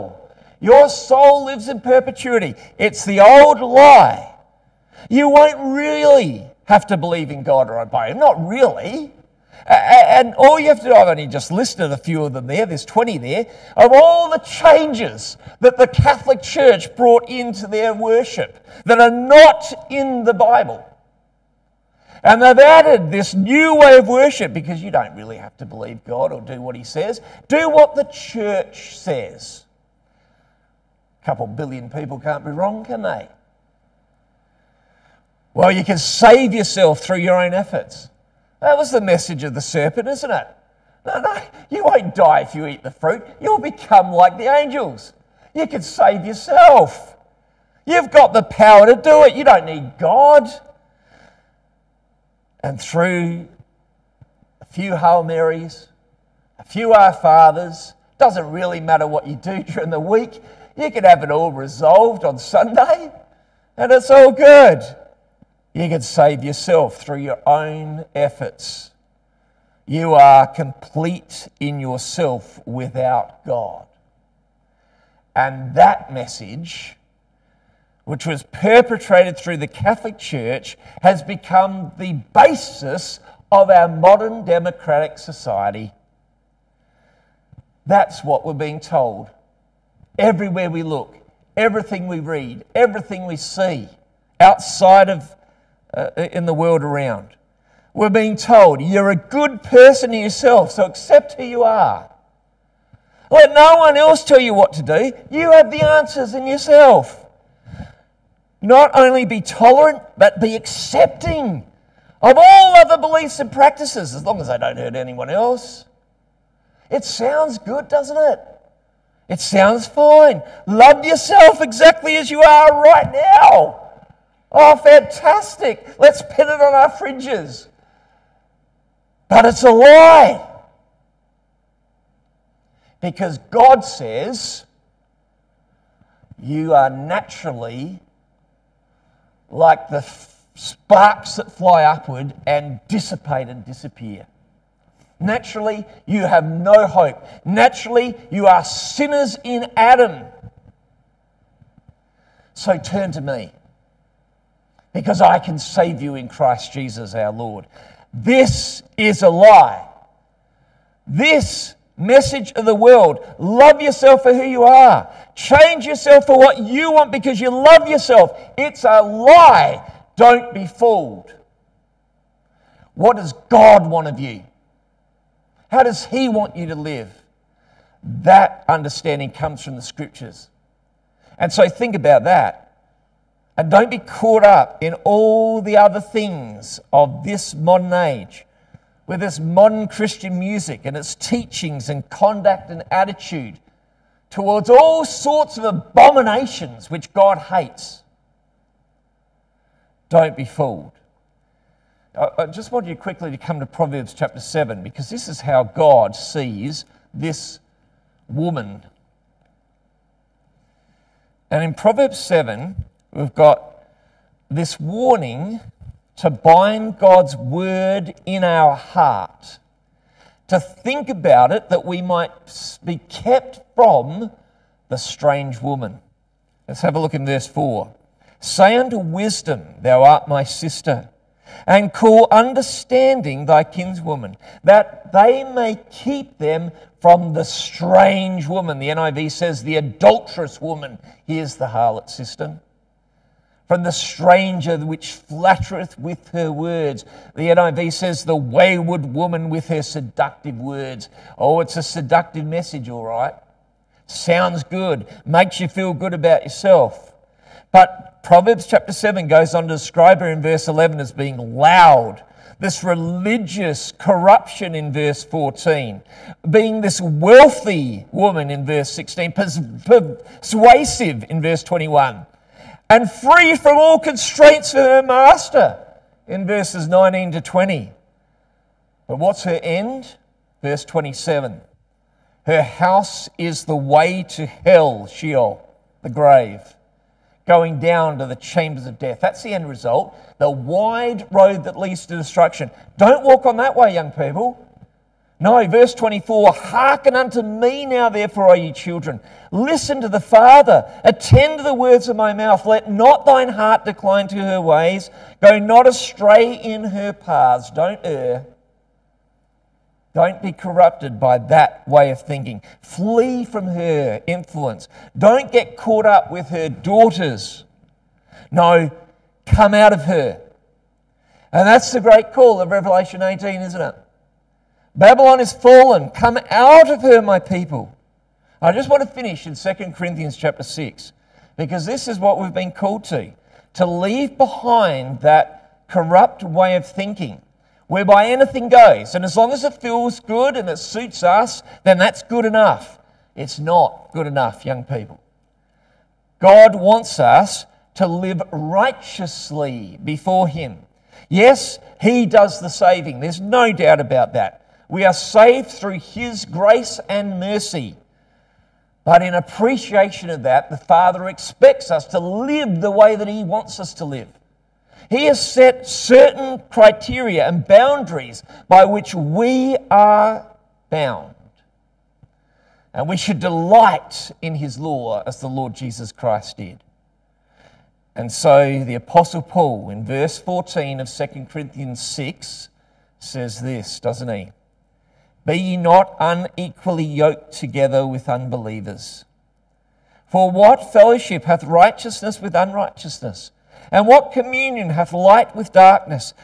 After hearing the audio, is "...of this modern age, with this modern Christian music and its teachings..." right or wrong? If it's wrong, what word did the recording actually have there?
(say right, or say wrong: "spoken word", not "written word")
right.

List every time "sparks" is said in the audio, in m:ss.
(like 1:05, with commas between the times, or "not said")
2:20.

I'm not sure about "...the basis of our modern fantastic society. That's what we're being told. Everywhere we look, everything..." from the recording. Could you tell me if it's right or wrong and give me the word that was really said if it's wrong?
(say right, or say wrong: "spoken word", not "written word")
wrong: "democratic", not "fantastic".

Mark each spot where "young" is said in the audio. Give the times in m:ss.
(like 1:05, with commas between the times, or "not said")
4:53, 5:44.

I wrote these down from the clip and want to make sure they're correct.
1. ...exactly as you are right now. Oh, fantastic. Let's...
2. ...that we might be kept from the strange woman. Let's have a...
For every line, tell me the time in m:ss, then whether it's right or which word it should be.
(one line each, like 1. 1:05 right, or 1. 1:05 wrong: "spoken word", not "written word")
1. 2:01 right
2. 3:41 right.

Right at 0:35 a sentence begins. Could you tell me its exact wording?
Well, you can save yourself through your own efforts.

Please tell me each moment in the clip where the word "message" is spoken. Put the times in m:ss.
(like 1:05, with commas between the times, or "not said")
0:38, 1:16, 2:41, 4:12.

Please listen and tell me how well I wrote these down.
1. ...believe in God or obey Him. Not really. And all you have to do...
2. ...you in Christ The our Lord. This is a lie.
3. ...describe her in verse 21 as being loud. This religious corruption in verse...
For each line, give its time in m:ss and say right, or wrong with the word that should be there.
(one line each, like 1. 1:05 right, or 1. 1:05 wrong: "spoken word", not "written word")
1. 0:06 right
2. 2:35 wrong: "Jesus", not "The"
3. 4:19 wrong: "11", not "21".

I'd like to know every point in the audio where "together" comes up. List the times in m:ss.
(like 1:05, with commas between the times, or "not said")
6:27.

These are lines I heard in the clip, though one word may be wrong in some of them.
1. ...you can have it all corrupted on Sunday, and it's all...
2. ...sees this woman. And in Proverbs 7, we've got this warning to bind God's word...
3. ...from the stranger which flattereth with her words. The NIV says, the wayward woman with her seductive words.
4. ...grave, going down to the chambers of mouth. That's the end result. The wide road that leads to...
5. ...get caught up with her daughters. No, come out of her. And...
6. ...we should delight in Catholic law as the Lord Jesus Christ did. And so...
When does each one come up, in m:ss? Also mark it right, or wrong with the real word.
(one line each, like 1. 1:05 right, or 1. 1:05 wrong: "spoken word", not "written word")
1. 1:00 wrong: "resolved", not "corrupted"
2. 3:26 right
3. 4:03 right
4. 4:46 wrong: "death", not "mouth"
5. 5:15 right
6. 6:13 wrong: "His", not "Catholic".